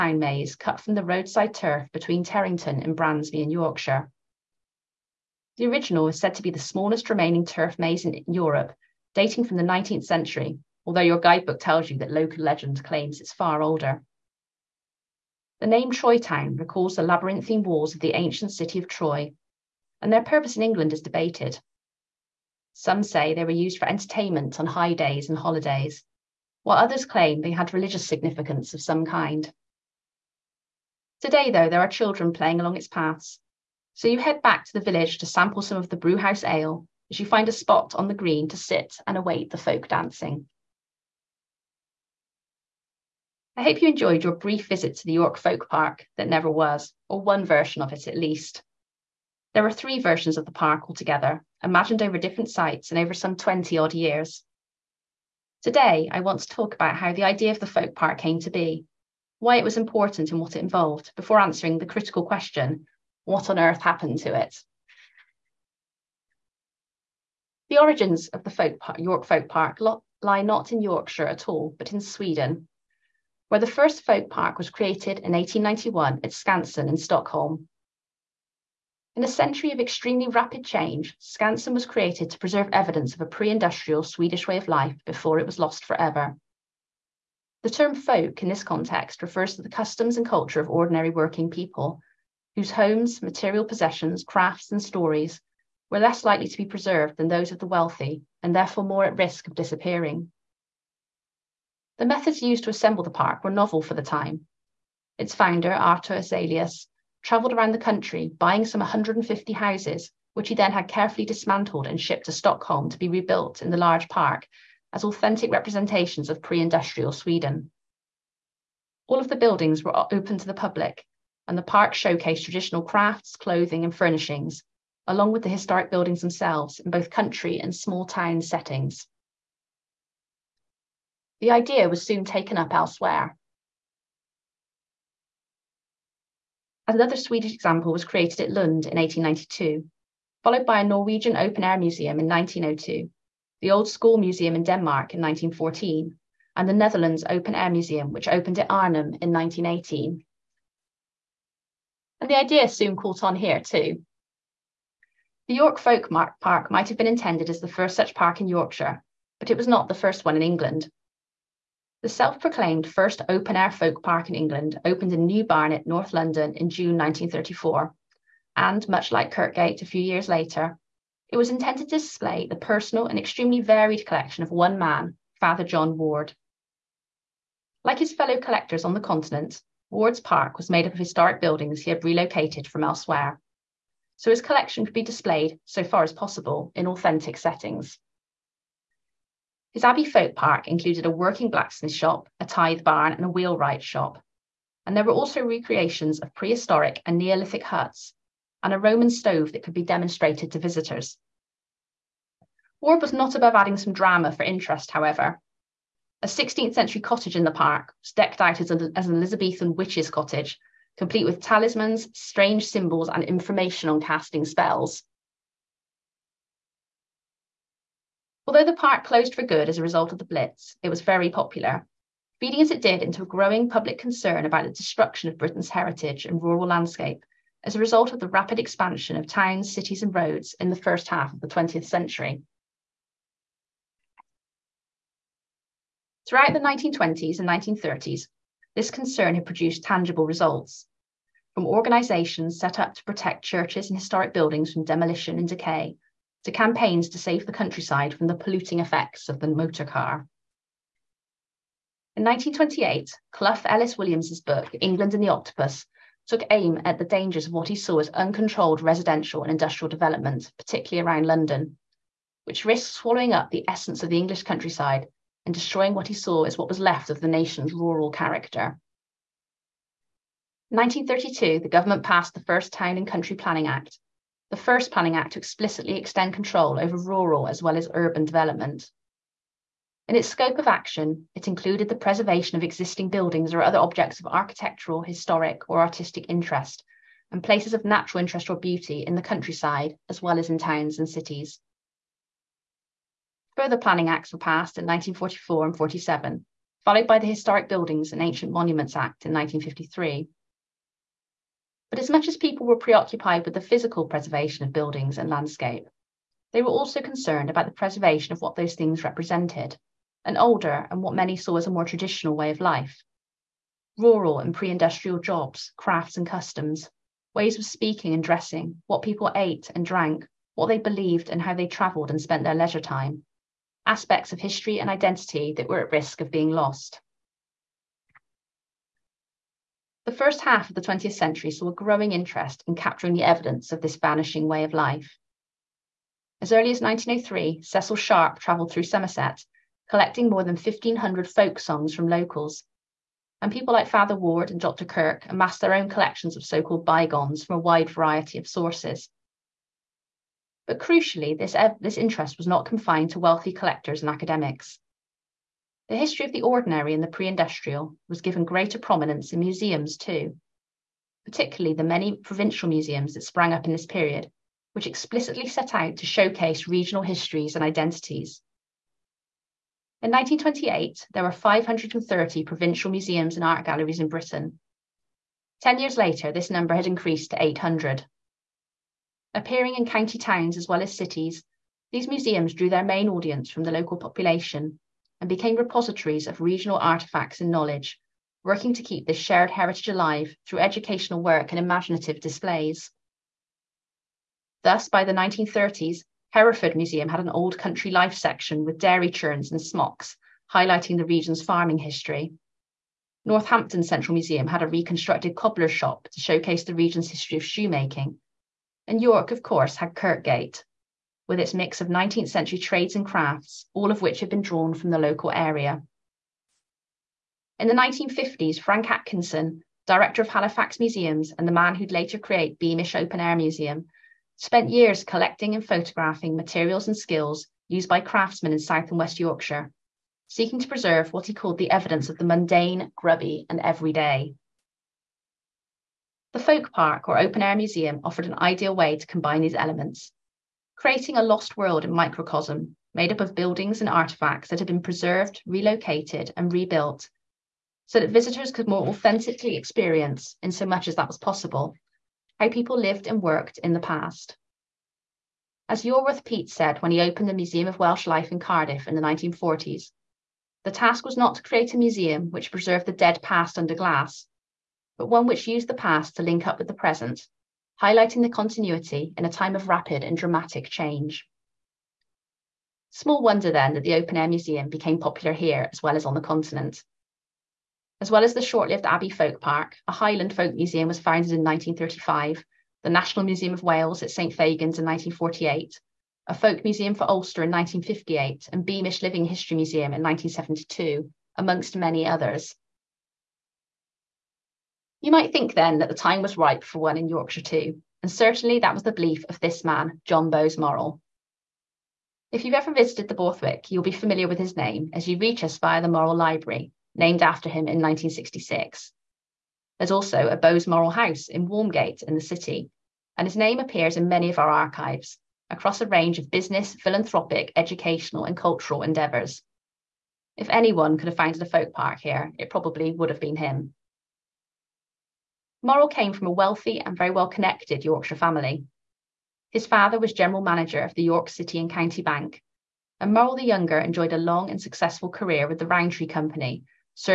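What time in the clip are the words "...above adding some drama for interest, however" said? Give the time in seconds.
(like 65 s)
203 s.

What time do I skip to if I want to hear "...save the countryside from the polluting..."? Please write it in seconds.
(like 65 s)
247 s.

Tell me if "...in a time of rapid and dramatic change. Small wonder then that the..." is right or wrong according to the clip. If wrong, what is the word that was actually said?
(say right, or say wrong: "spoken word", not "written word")
right.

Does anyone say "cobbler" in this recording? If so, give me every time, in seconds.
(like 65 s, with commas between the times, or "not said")
405 s.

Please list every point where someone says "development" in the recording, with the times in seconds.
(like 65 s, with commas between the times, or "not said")
259 s, 278 s.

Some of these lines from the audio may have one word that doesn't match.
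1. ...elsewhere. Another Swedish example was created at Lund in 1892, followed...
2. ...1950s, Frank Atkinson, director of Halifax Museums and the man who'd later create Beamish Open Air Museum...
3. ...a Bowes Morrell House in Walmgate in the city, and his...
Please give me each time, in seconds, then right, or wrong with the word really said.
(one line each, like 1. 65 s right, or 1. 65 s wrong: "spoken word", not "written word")
1. 132 s right
2. 417 s right
3. 510 s right.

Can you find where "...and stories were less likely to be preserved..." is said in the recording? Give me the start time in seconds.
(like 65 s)
94 s.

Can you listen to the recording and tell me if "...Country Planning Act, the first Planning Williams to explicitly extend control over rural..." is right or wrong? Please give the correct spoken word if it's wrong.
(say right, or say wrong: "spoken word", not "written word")
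wrong: "Act", not "Williams".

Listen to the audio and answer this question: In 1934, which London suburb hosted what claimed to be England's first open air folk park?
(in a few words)
New Barnet.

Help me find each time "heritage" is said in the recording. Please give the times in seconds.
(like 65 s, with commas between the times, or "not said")
225 s, 389 s.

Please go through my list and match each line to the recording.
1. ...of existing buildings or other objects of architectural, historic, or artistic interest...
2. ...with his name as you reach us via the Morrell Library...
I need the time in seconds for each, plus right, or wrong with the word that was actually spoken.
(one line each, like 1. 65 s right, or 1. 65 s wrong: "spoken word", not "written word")
1. 282 s right
2. 504 s right.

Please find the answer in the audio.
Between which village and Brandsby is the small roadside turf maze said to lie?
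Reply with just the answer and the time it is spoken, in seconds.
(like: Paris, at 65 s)
Terrington, at 2 s.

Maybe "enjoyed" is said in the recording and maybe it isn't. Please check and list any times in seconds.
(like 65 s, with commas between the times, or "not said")
43 s, 533 s.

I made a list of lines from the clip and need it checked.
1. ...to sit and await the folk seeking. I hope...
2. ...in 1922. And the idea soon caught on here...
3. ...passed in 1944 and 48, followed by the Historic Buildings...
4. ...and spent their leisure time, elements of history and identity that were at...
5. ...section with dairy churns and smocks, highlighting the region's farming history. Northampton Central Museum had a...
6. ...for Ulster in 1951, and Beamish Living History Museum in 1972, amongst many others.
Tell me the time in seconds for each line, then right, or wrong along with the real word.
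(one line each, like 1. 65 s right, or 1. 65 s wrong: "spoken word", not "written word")
1. 38 s wrong: "dancing", not "seeking"
2. 149 s wrong: "1918", not "1922"
3. 294 s wrong: "47", not "48"
4. 322 s wrong: "aspects", not "elements"
5. 398 s right
6. 486 s wrong: "1958", not "1951".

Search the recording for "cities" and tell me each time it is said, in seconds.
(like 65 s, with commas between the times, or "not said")
229 s, 291 s, 380 s.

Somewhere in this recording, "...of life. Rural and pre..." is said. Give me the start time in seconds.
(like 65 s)
312 s.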